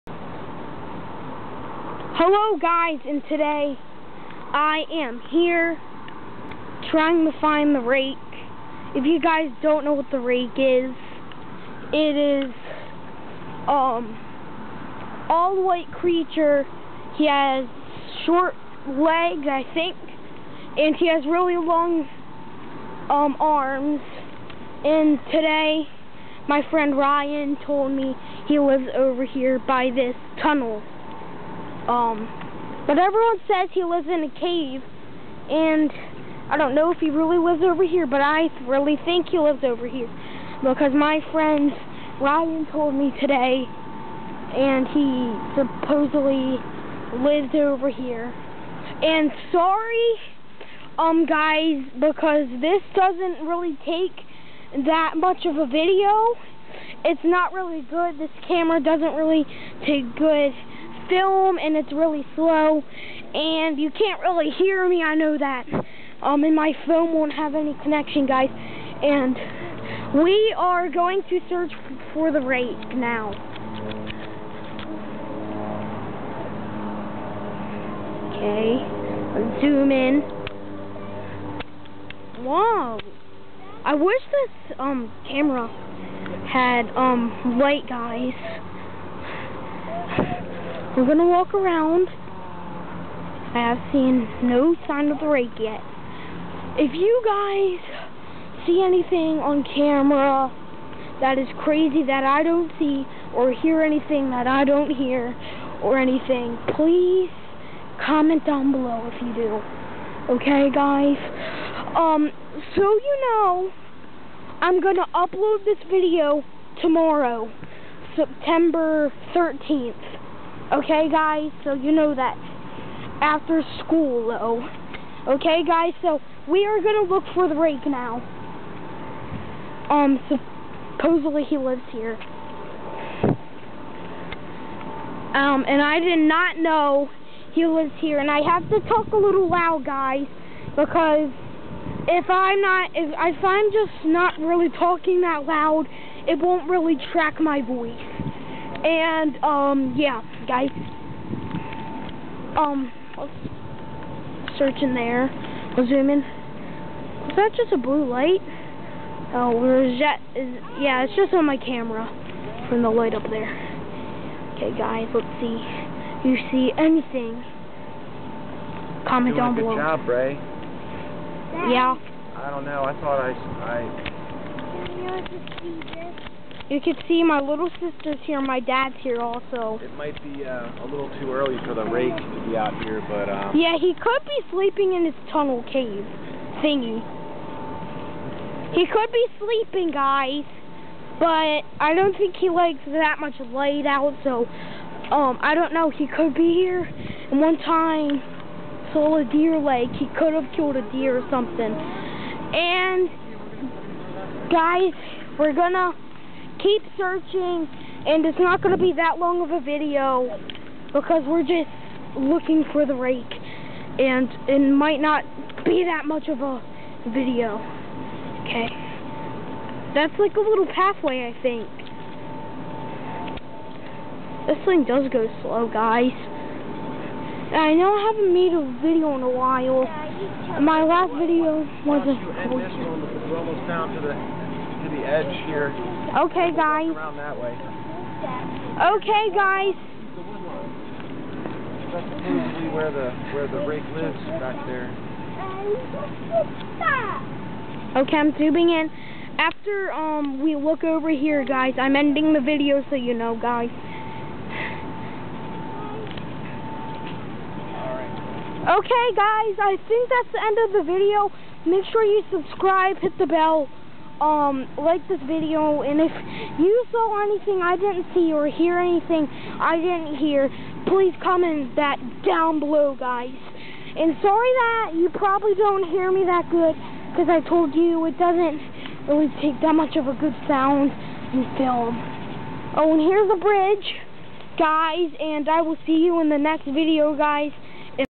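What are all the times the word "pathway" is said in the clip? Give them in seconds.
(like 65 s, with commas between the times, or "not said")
220 s.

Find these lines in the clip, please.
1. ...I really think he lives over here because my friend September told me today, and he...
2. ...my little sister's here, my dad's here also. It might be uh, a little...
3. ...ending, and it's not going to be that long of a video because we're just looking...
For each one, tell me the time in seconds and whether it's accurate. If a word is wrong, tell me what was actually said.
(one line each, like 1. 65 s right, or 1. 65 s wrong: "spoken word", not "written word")
1. 38 s wrong: "Ryan", not "September"
2. 177 s right
3. 206 s wrong: "searching", not "ending".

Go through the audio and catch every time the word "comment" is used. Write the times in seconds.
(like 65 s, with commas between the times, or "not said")
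108 s, 169 s, 271 s.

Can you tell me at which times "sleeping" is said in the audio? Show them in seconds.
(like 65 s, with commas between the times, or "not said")
184 s, 189 s.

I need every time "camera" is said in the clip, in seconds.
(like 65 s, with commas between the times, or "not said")
58 s, 85 s, 99 s, 161 s.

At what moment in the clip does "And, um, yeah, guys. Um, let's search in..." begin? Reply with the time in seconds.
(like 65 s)
148 s.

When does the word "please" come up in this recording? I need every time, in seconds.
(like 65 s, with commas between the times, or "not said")
106 s, 270 s.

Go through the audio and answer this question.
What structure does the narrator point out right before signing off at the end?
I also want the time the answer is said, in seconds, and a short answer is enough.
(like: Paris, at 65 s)
the bridge, at 283 s.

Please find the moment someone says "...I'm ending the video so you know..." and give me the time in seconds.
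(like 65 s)
251 s.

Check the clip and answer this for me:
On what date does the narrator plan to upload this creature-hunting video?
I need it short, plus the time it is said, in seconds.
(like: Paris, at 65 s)
September 13th, at 118 s.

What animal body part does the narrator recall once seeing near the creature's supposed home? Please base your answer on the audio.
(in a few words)
deer leg.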